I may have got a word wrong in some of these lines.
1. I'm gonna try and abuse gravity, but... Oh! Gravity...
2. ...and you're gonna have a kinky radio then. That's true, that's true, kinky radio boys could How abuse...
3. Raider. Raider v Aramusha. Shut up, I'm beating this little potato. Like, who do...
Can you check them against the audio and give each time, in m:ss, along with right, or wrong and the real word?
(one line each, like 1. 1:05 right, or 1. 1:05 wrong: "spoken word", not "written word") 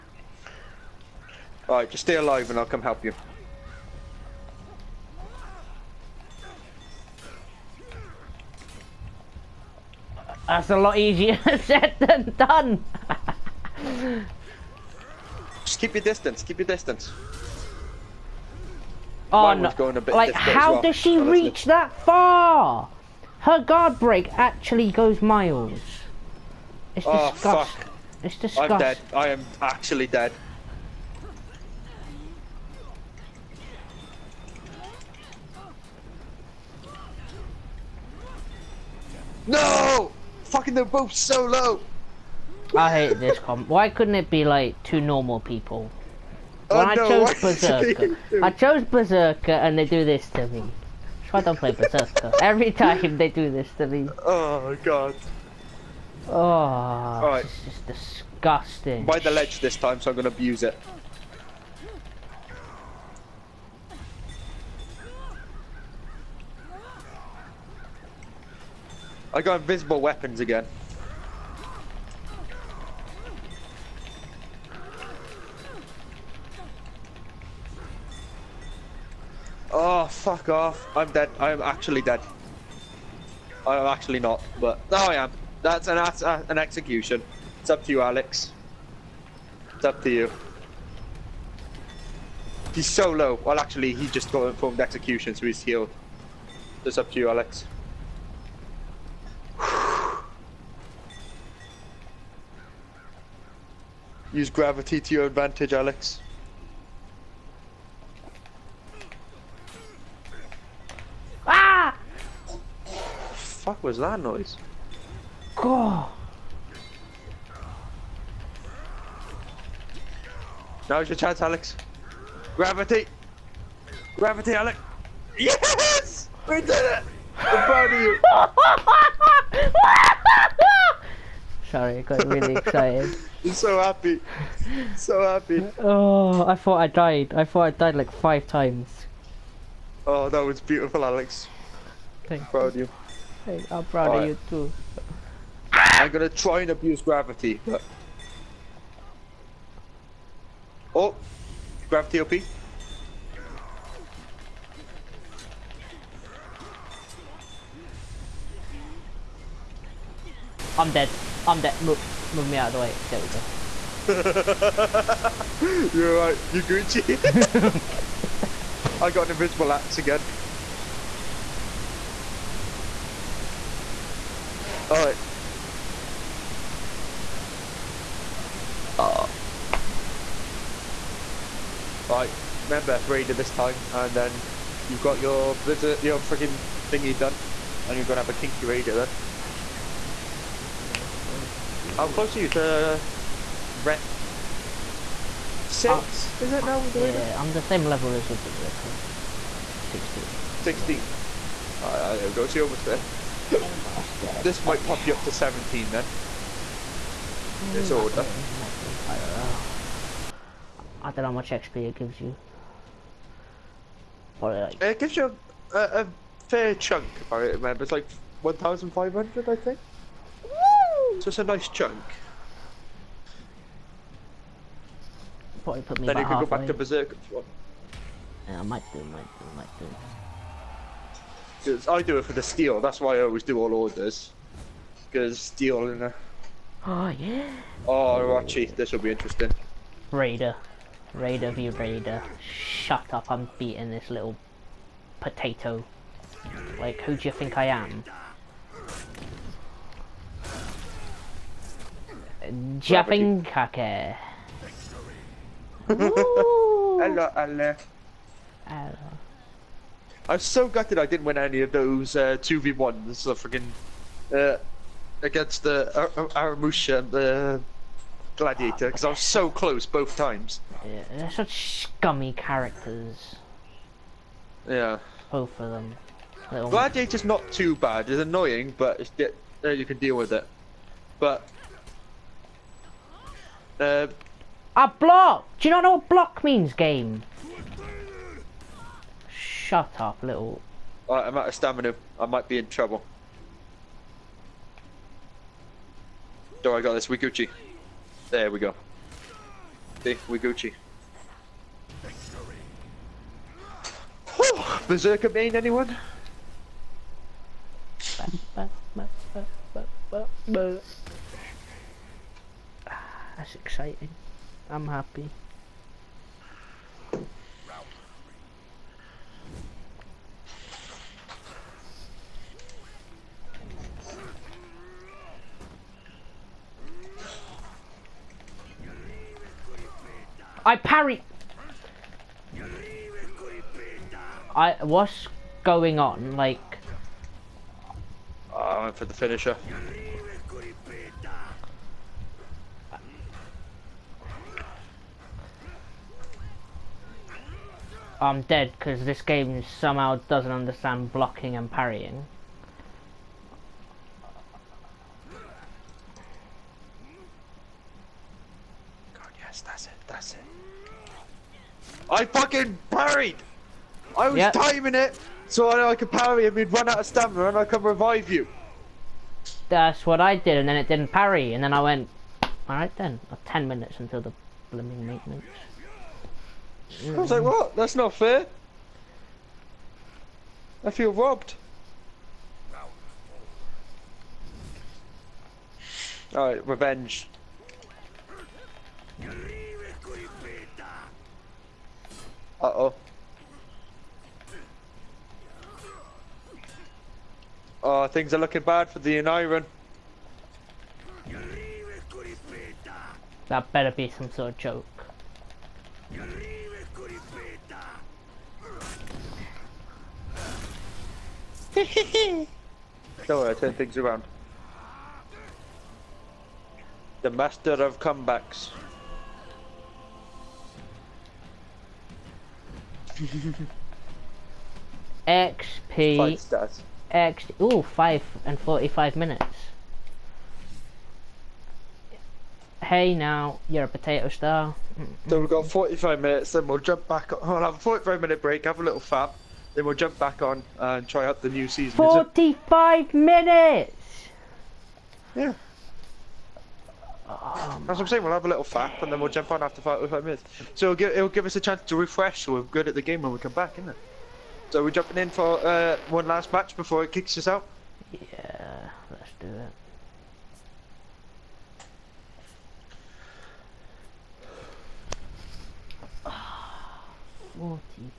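1. 2:25 right
2. 3:07 wrong: "close", not "abuse"
3. 4:00 wrong: "Raider", not "Aramusha".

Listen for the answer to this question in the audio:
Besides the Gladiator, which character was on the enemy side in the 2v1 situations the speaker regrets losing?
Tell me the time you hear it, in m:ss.
4:26.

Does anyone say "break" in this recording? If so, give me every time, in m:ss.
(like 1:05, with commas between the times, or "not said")
0:23, 7:18.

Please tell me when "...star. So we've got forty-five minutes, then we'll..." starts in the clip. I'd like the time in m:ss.
7:14.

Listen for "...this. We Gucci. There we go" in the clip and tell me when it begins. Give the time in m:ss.
4:56.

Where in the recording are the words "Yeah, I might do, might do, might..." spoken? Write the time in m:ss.
3:48.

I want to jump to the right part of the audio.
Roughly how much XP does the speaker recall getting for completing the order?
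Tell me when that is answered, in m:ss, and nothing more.
3:38.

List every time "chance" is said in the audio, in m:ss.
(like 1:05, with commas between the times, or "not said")
2:01, 7:31.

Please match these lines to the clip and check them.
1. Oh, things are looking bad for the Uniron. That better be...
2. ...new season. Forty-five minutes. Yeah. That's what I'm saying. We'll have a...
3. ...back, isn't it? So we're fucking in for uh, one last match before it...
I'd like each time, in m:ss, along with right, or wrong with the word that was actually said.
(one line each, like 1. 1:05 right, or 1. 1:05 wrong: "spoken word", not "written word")
1. 6:37 right
2. 7:21 right
3. 7:33 wrong: "jumping", not "fucking".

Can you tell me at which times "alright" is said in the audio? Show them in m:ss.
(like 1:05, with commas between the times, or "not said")
0:01, 2:54, 3:02, 6:12, 6:26.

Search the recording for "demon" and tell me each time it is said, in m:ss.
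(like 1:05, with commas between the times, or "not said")
not said.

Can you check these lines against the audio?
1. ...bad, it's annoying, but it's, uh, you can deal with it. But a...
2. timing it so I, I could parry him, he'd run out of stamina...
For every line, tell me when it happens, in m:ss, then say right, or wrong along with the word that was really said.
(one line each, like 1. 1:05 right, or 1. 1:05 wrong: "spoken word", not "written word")
1. 4:37 right
2. 6:04 right.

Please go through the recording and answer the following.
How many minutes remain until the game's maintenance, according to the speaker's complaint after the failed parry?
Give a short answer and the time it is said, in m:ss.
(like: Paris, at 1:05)
10, at 6:13.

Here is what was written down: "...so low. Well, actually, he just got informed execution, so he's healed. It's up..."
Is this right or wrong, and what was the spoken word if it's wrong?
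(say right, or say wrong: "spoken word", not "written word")
right.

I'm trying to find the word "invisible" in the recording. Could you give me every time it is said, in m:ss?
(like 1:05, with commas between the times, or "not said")
1:09, 2:49.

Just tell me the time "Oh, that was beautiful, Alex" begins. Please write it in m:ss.
2:20.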